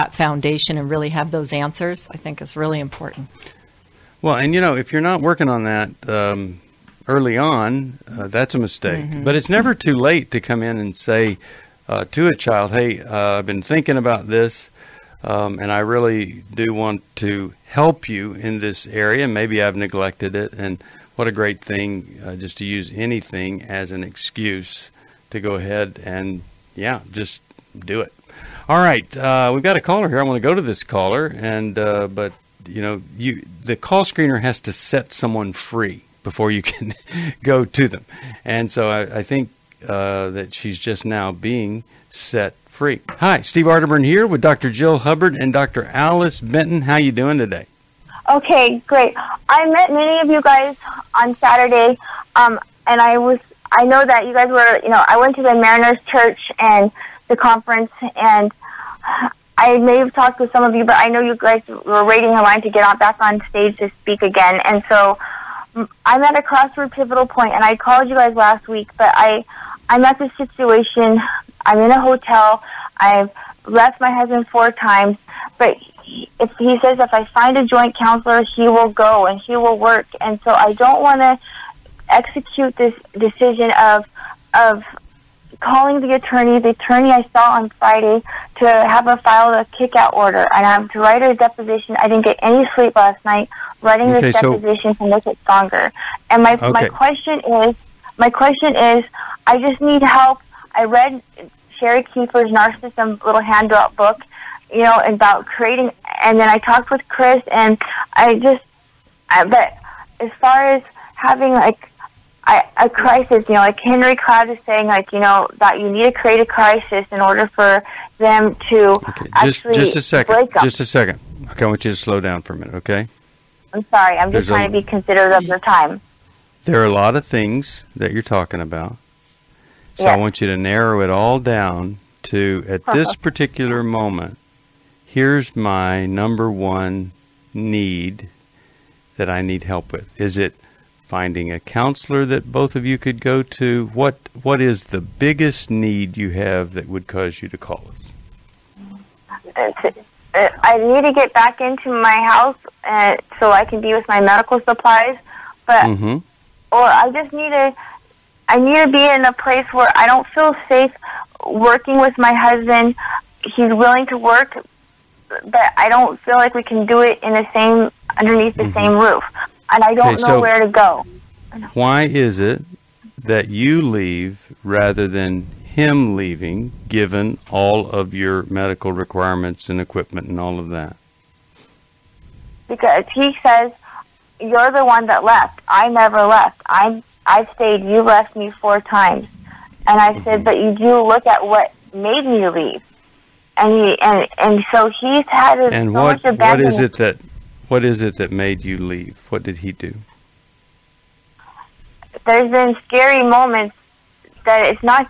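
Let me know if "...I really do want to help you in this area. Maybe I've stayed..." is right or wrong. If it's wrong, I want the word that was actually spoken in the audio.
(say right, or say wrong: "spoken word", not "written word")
wrong: "neglected", not "stayed".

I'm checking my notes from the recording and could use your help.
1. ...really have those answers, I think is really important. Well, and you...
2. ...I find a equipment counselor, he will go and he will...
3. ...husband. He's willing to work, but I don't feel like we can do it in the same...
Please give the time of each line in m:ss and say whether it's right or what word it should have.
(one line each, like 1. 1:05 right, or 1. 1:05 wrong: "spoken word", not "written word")
1. 0:00 right
2. 1:17 wrong: "joint", not "equipment"
3. 2:42 right.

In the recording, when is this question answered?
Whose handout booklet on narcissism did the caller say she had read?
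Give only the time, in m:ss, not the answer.
1:41.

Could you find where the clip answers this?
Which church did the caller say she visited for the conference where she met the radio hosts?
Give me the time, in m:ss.
0:55.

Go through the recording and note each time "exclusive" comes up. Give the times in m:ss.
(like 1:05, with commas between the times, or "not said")
not said.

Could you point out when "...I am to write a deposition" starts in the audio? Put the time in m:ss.
1:30.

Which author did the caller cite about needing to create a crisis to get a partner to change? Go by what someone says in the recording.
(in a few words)
Henry Cloud.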